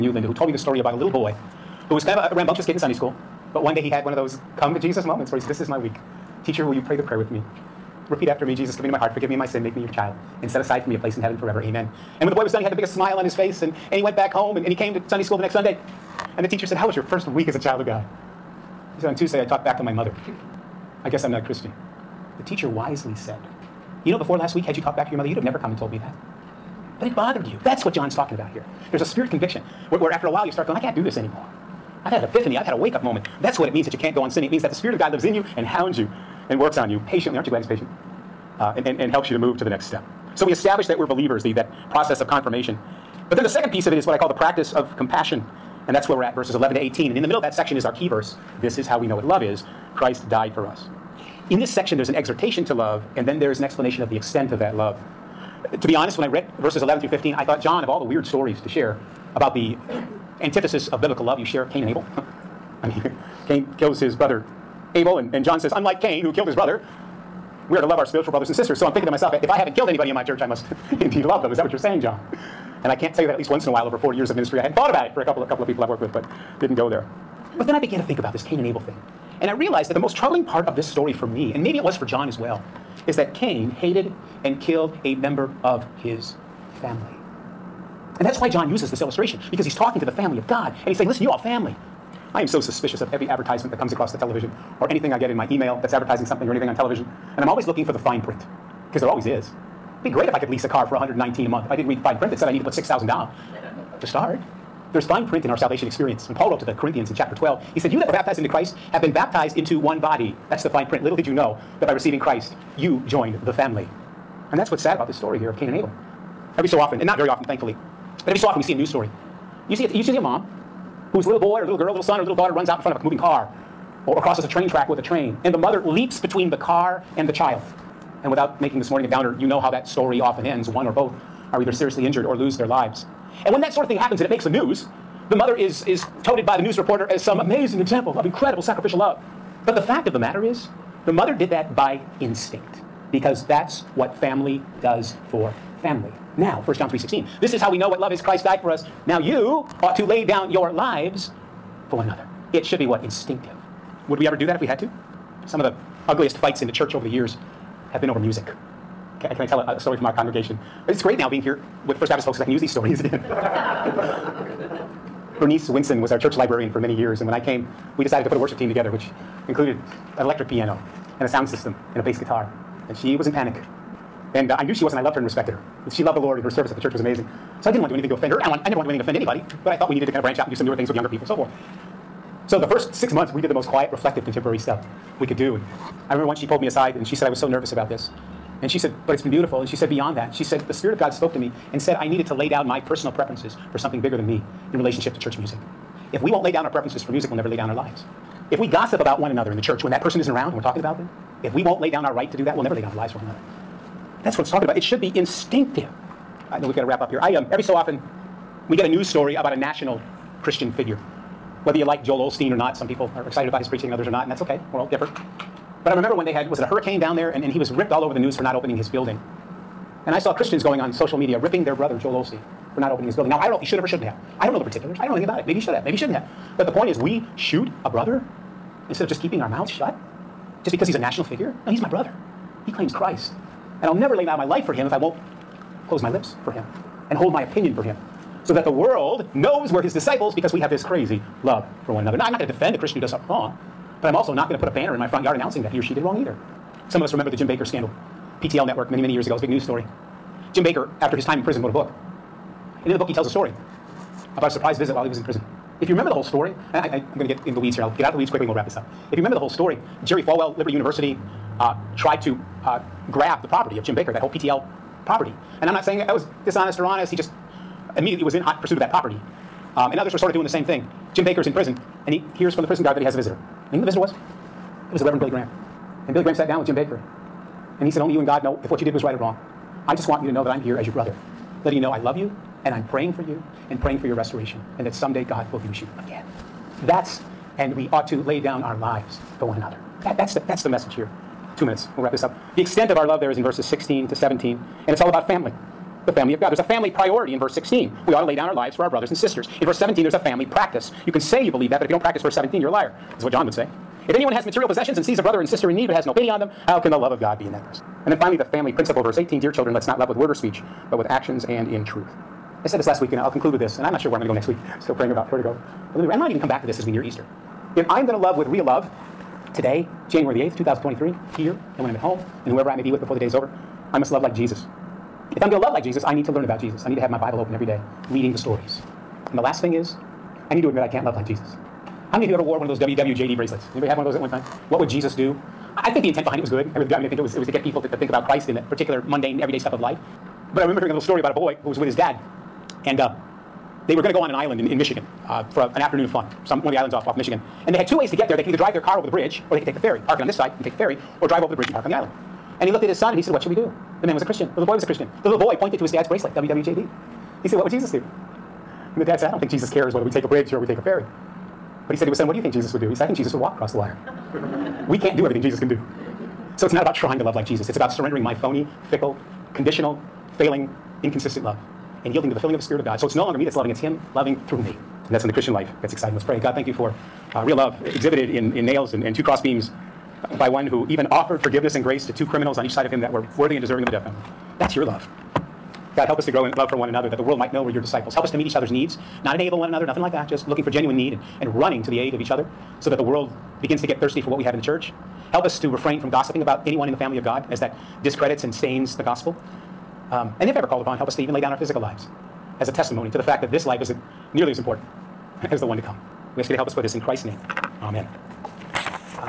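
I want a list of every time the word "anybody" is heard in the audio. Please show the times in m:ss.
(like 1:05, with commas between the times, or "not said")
1:09, 2:59, 5:33.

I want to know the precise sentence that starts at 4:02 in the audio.
Now, I'm not going to defend a Christian who does something wrong.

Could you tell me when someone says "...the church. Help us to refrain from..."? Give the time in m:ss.
6:34.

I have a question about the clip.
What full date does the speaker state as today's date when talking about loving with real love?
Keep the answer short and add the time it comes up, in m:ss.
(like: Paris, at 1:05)
January 8, 2023, at 5:20.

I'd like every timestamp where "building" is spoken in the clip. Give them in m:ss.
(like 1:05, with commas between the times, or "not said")
3:38, 3:43.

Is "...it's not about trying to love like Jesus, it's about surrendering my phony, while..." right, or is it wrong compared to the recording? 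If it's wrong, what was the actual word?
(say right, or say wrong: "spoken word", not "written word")
wrong: "fickle", not "while".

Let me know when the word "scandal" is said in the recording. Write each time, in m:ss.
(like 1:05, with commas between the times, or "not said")
4:07.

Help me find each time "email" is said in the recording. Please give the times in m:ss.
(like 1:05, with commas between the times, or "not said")
1:35.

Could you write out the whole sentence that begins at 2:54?
And uh, I knew she was, and I loved her and respected her.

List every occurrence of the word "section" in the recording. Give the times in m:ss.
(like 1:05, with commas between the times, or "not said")
0:47, 0:51.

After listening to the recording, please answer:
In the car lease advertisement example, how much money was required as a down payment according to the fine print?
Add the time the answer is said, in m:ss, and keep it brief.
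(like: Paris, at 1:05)
6,000, at 1:42.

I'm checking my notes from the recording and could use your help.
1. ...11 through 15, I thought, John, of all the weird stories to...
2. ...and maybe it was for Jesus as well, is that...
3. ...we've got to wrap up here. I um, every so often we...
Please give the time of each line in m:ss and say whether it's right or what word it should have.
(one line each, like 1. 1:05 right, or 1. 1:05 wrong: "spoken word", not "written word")
1. 0:56 right
2. 1:21 wrong: "John", not "Jesus"
3. 3:26 right.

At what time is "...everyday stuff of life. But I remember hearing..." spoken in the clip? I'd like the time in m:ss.
5:39.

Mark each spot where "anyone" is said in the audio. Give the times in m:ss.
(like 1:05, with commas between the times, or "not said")
5:04, 6:36.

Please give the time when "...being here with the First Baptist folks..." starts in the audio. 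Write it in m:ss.
2:41.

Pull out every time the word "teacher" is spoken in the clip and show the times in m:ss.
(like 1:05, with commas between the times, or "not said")
0:06, 0:16, 0:22.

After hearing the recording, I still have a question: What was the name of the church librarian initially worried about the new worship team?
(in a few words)
Bernice Winson.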